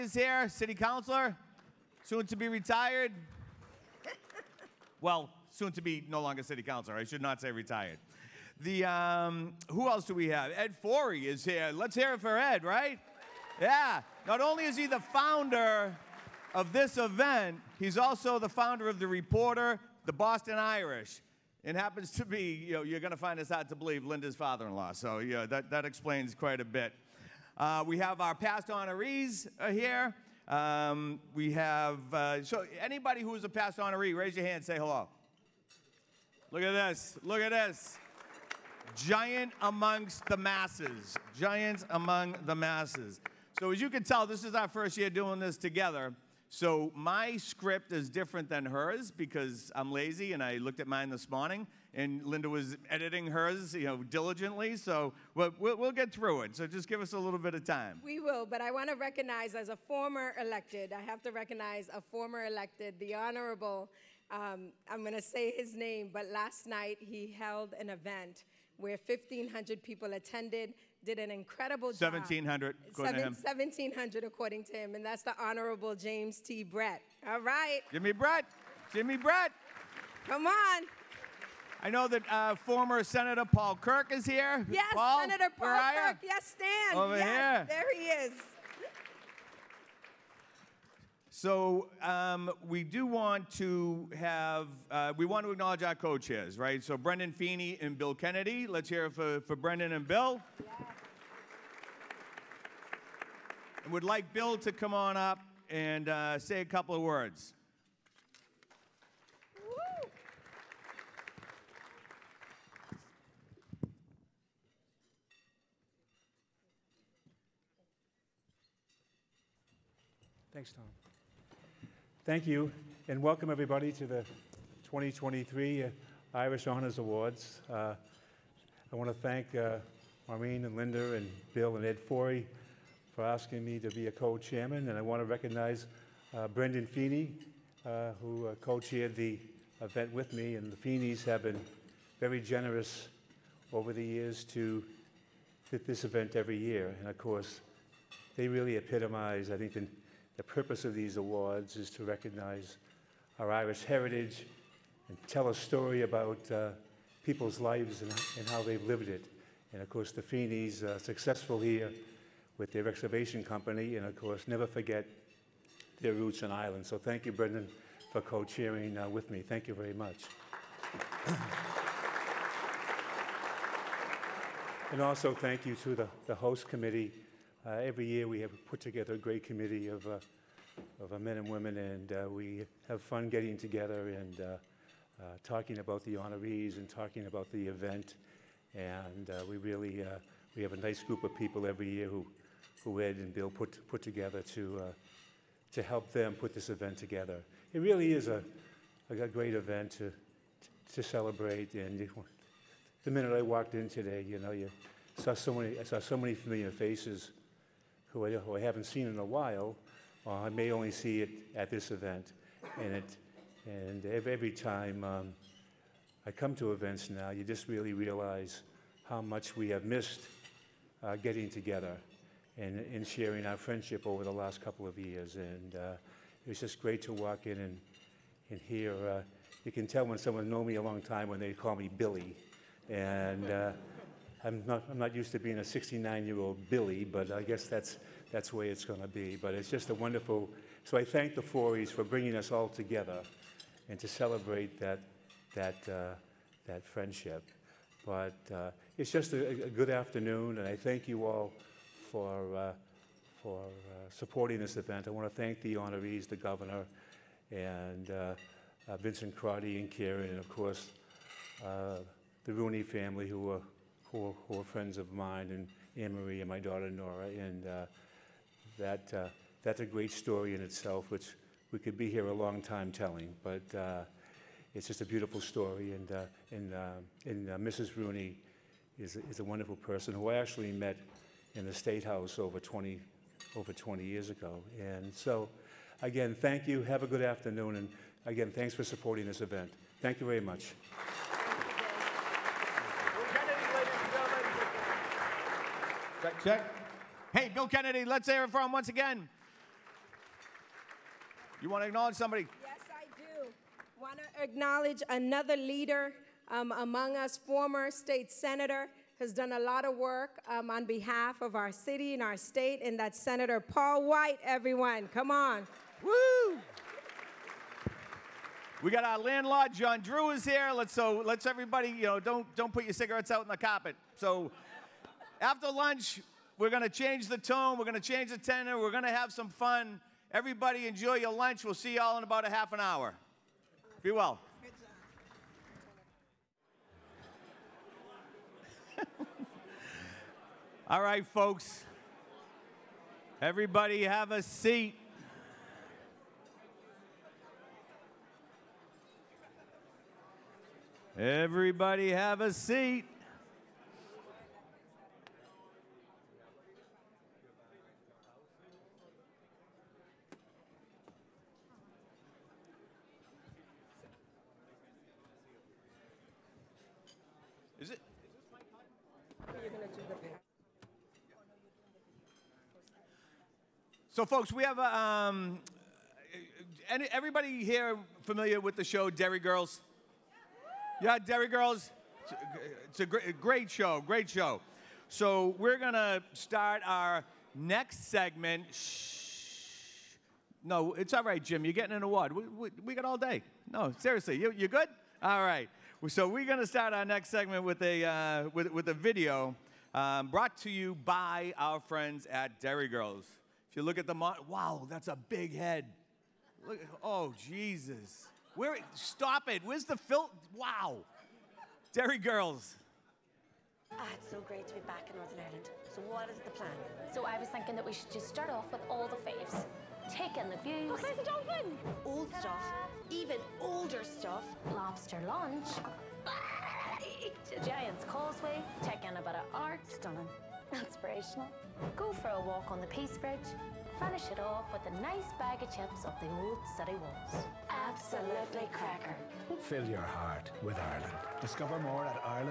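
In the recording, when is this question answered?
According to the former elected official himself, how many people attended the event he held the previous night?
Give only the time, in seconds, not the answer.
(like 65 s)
73 s.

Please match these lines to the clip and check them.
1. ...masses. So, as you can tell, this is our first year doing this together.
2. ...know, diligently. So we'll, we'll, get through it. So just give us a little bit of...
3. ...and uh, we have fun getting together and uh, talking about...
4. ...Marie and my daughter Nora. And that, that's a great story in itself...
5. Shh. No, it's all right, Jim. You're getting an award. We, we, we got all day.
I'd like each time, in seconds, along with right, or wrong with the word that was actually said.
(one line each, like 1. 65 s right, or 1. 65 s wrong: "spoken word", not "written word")
1. 42 s right
2. 53 s right
3. 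181 s right
4. 266 s right
5. 388 s right.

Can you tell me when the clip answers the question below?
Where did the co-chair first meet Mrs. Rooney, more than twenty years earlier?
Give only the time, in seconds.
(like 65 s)
281 s.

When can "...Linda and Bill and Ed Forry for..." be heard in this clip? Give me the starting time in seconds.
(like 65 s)
130 s.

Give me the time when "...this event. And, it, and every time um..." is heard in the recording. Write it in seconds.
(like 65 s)
211 s.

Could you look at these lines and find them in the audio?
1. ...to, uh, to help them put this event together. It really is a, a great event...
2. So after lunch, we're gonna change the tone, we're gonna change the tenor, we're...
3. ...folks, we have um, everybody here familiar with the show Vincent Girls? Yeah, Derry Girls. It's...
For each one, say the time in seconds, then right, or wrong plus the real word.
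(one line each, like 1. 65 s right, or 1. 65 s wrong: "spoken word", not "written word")
1. 194 s right
2. 324 s right
3. 374 s wrong: "Derry", not "Vincent".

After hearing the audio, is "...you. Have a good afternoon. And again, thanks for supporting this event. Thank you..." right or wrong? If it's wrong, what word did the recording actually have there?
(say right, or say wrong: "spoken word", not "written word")
right.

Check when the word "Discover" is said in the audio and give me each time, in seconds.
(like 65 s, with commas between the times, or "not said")
441 s.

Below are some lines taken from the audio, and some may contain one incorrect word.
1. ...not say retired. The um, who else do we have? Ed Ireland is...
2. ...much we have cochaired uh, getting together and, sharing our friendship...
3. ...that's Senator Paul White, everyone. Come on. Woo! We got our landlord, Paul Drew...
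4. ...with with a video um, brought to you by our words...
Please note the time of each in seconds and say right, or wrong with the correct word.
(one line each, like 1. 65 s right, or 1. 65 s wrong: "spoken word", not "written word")
1. 7 s wrong: "Forry", not "Ireland"
2. 219 s wrong: "missed", not "cochaired"
3. 312 s wrong: "John", not "Paul"
4. 398 s wrong: "friends", not "words".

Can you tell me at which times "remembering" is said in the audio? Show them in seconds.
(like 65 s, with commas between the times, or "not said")
not said.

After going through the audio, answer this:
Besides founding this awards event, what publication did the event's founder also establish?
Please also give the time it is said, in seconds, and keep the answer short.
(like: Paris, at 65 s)
The Reporter, at 18 s.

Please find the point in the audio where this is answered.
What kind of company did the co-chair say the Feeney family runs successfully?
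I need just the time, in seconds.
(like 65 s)
162 s.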